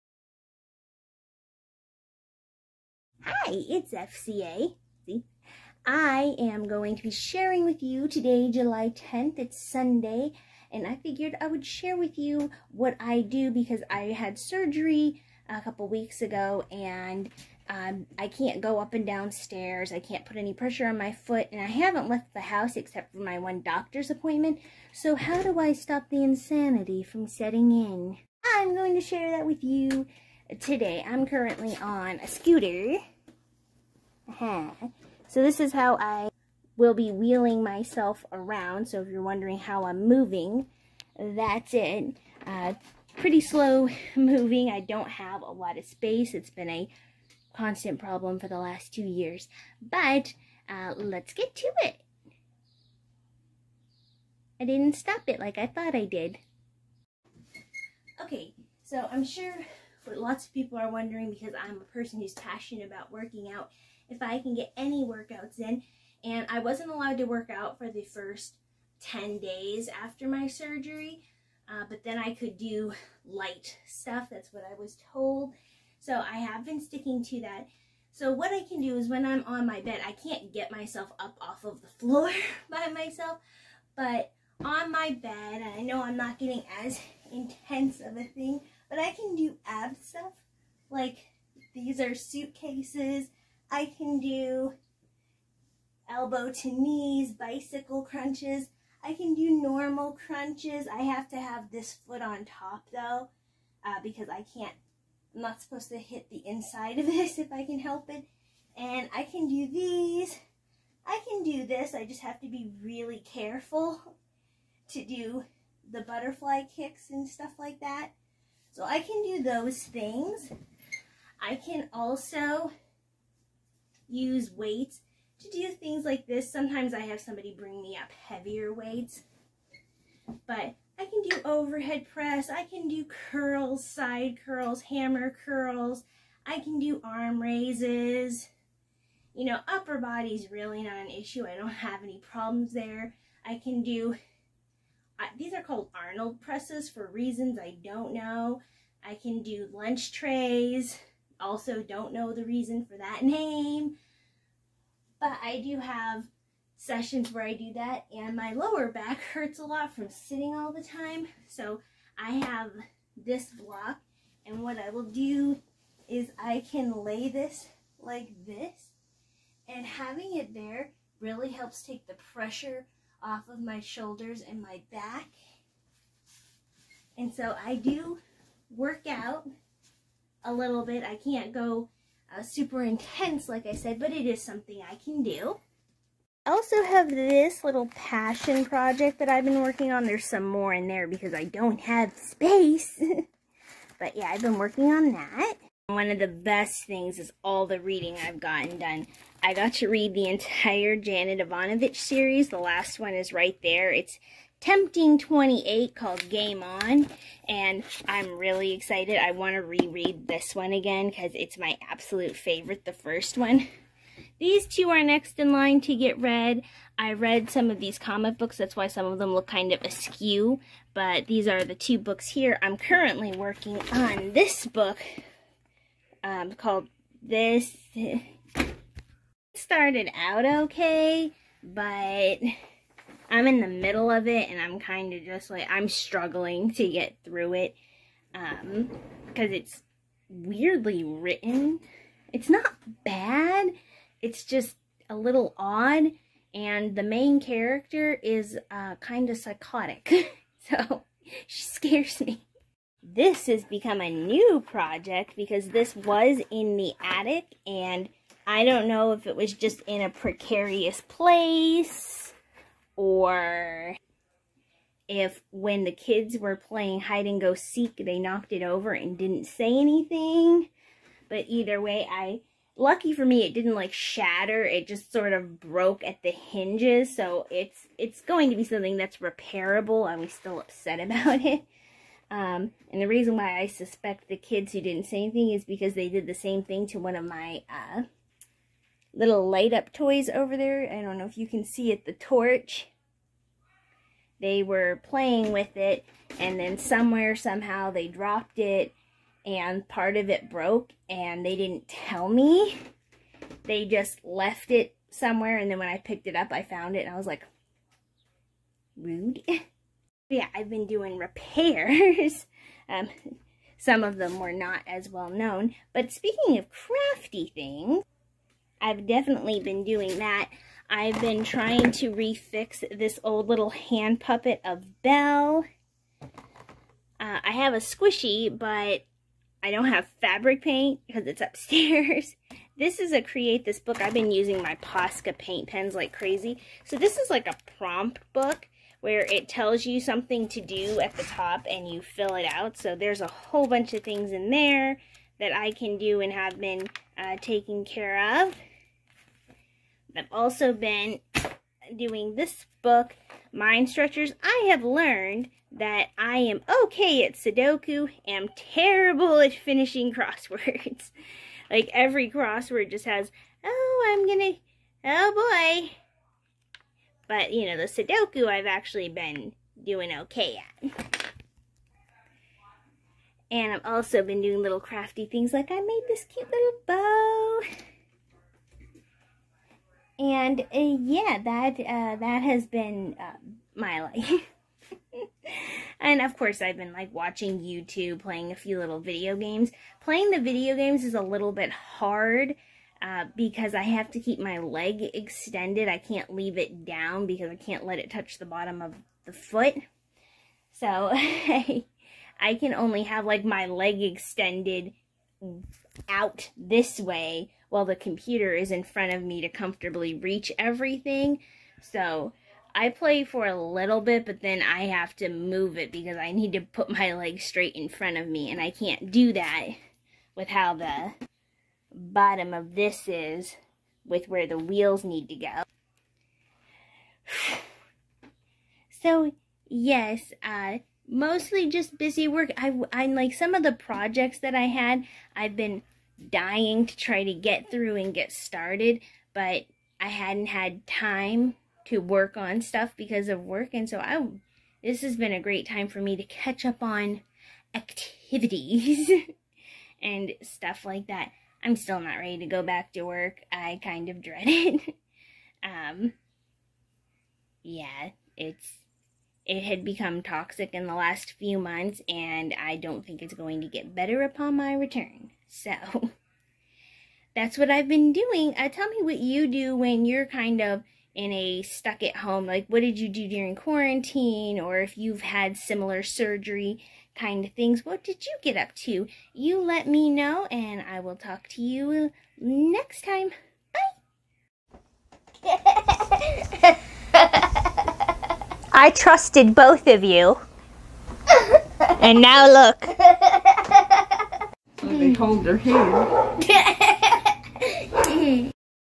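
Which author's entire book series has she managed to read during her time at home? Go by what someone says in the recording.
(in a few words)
Janet Evanovich.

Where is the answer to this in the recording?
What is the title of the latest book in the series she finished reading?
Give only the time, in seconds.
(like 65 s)
206 s.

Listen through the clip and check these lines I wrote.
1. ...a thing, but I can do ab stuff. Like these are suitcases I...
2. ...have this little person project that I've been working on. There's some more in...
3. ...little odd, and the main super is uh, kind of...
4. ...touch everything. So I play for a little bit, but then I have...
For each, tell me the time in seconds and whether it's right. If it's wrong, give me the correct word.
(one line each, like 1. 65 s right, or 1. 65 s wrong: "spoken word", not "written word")
1. 88 s right
2. 186 s wrong: "passion", not "person"
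3. 245 s wrong: "character", not "super"
4. 410 s wrong: "reach", not "touch".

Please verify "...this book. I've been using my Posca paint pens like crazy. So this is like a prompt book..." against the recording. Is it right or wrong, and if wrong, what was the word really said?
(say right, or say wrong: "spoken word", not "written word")
right.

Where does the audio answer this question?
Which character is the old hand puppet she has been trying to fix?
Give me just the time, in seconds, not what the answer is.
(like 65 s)
325 s.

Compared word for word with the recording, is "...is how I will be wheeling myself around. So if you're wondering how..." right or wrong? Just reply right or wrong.
right.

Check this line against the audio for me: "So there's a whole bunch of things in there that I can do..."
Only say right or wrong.
right.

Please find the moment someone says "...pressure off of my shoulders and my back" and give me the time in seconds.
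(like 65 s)
172 s.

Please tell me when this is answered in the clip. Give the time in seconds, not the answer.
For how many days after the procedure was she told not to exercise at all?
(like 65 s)
69 s.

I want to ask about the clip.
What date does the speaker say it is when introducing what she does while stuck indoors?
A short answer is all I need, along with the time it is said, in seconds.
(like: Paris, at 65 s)
July 10th, at 8 s.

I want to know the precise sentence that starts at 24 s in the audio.
So how do I stop the insanity from setting in?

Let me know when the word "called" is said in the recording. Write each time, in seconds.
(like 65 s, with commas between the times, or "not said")
145 s, 205 s, 226 s.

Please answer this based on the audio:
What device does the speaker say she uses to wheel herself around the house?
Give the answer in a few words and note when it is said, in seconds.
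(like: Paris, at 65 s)
A scooter, at 32 s.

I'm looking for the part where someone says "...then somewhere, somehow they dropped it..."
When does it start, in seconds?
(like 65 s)
296 s.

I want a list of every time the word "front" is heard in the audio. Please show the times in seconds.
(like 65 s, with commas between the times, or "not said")
408 s, 417 s.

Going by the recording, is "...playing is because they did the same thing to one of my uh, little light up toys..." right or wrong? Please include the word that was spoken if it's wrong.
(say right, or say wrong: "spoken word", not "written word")
wrong: "anything", not "playing".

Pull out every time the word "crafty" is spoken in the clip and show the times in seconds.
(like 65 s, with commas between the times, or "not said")
316 s, 374 s.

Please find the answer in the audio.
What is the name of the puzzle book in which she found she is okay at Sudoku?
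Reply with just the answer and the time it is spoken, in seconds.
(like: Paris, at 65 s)
Mind Stretchers, at 353 s.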